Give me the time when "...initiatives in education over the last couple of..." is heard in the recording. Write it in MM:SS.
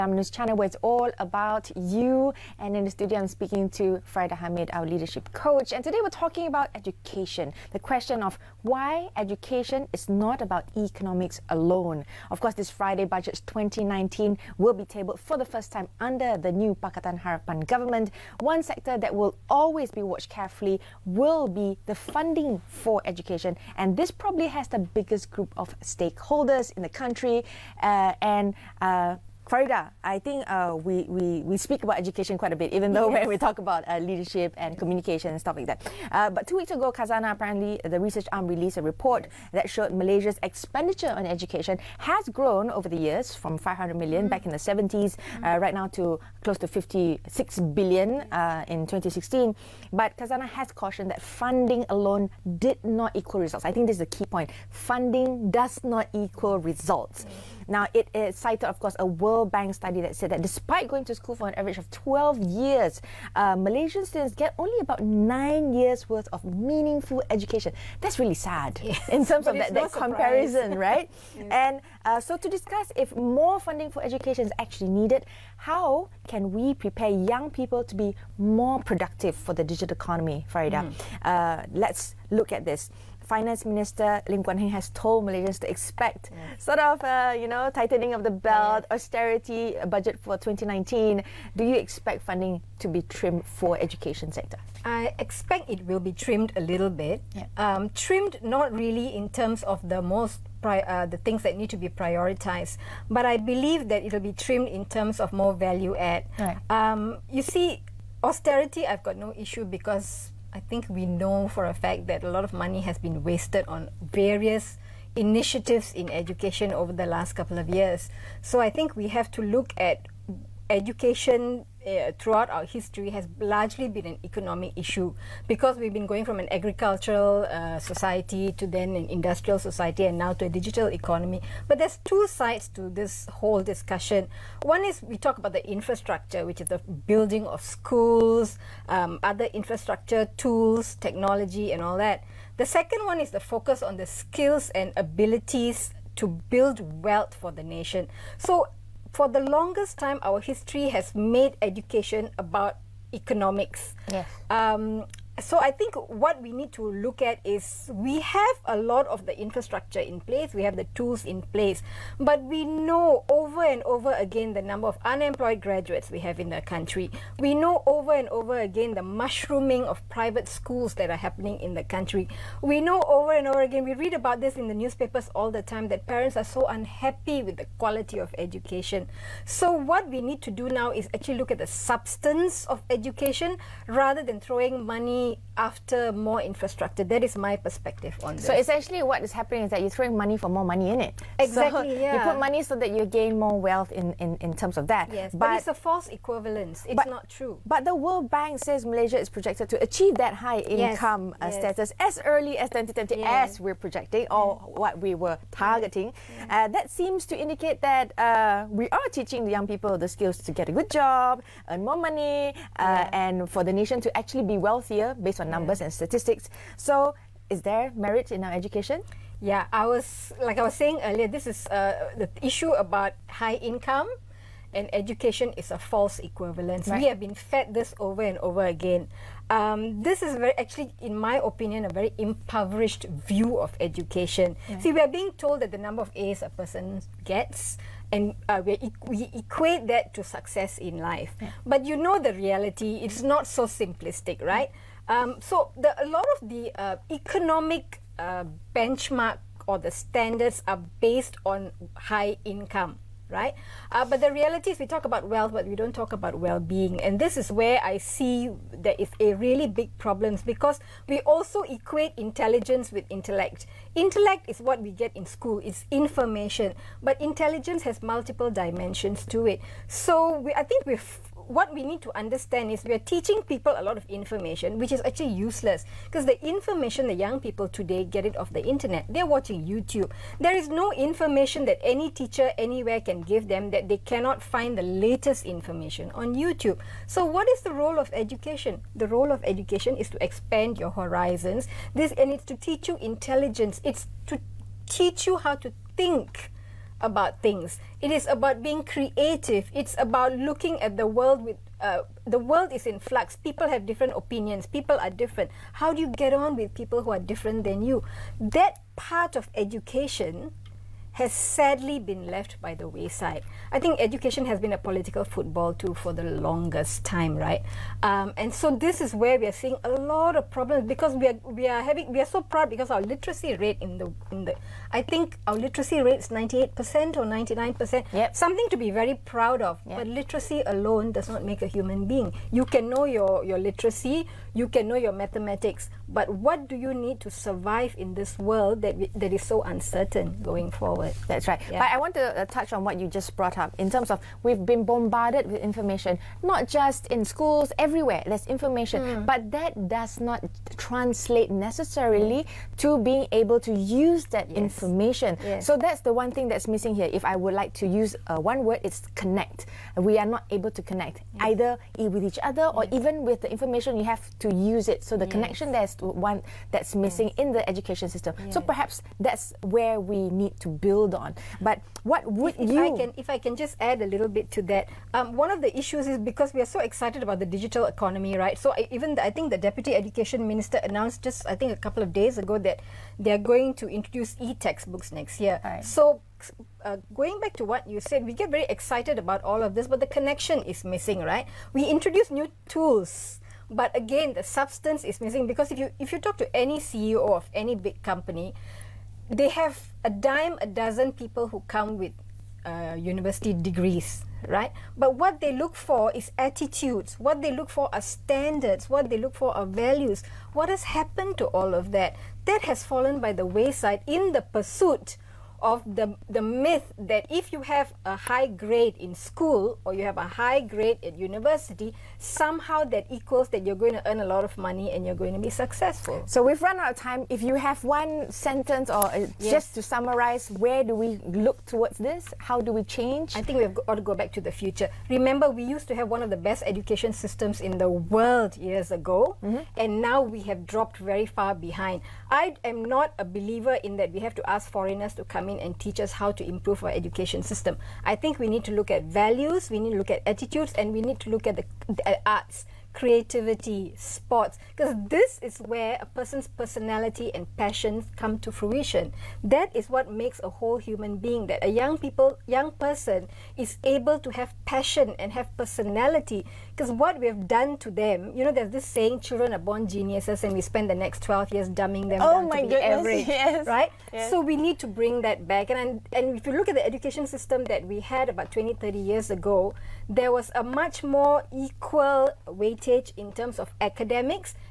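01:55.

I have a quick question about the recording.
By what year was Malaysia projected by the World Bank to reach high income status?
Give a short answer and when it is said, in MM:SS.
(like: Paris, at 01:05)
2020, at 03:22.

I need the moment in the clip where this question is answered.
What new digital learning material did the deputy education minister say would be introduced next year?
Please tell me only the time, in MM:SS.
06:24.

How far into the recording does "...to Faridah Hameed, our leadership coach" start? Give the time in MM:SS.
00:03.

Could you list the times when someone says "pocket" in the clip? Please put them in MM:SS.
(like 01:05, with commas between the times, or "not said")
not said.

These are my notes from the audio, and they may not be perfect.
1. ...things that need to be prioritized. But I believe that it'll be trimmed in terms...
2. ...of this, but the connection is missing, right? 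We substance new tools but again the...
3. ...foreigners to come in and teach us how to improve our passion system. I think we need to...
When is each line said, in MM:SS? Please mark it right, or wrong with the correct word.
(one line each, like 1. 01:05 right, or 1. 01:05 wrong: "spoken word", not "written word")
1. 01:41 right
2. 06:29 wrong: "introduce", not "substance"
3. 07:24 wrong: "education", not "passion".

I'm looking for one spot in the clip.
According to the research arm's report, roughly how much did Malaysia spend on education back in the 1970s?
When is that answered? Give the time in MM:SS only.
00:43.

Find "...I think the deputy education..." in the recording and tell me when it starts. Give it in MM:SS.
06:19.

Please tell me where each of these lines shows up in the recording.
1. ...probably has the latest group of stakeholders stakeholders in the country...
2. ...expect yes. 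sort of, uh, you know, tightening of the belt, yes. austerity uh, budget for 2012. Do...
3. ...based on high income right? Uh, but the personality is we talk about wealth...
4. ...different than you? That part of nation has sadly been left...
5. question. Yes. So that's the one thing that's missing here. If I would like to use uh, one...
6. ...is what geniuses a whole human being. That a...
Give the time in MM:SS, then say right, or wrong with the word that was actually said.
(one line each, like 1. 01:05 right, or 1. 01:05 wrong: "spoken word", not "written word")
1. 00:24 wrong: "biggest", not "latest"
2. 01:25 wrong: "2019", not "2012"
3. 04:11 wrong: "reality", not "personality"
4. 05:07 wrong: "education", not "nation"
5. 05:54 wrong: "information", not "question"
6. 07:39 wrong: "makes", not "geniuses".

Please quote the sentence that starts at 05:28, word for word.
Something to be very proud of.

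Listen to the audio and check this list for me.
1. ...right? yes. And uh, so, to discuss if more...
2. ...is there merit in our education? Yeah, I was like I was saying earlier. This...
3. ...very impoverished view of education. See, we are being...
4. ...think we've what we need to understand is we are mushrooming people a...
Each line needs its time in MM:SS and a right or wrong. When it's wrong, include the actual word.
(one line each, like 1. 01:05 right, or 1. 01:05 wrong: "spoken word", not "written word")
1. 01:10 right
2. 03:37 right
3. 03:51 right
4. 04:30 wrong: "teaching", not "mushrooming".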